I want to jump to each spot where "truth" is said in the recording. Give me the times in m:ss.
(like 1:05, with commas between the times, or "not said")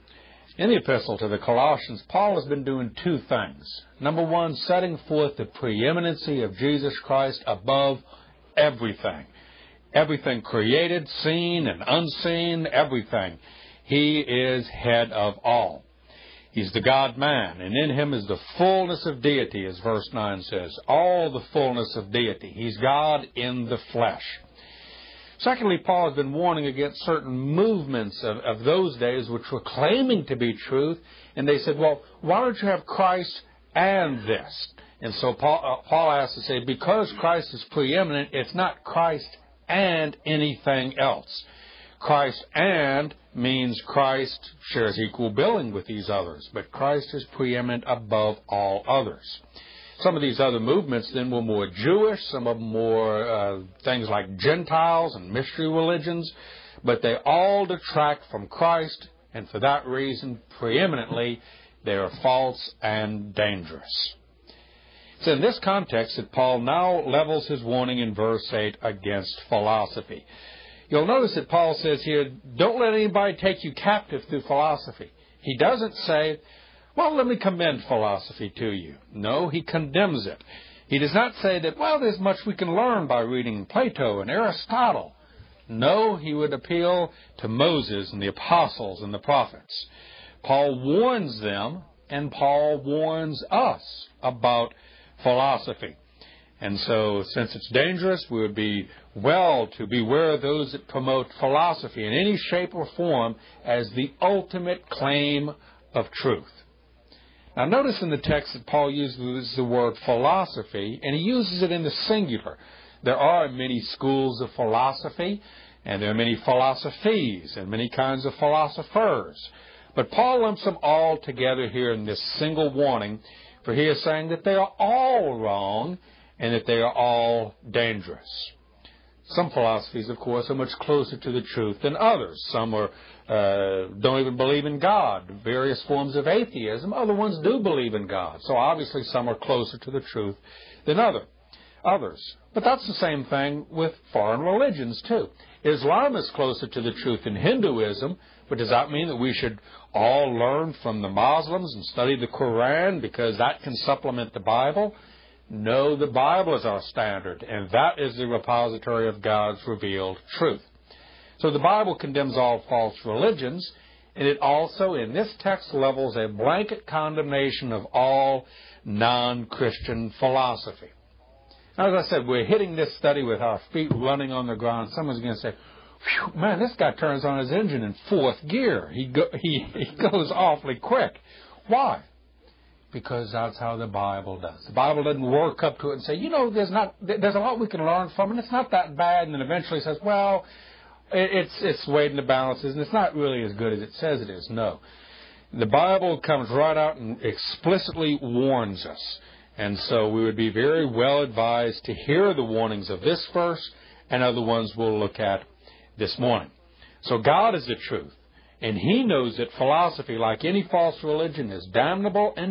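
0:30, 1:46, 2:11, 2:19, 2:27, 2:40, 3:27.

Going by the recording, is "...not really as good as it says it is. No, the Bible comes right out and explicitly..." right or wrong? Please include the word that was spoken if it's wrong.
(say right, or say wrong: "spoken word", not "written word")
right.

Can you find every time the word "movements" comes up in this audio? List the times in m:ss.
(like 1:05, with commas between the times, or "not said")
0:27, 0:50.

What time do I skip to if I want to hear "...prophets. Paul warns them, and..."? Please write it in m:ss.
1:29.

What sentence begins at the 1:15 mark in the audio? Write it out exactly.
He doesn't say, well, let me commend philosophy to you.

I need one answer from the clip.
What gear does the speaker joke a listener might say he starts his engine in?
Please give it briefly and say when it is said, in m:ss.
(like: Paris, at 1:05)
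fourth gear, at 2:58.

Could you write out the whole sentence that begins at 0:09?
Everything created, seen, and unseen, everything.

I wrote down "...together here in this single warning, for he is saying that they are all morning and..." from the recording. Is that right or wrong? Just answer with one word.
wrong.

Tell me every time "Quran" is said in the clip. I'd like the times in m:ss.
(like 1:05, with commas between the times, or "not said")
2:32.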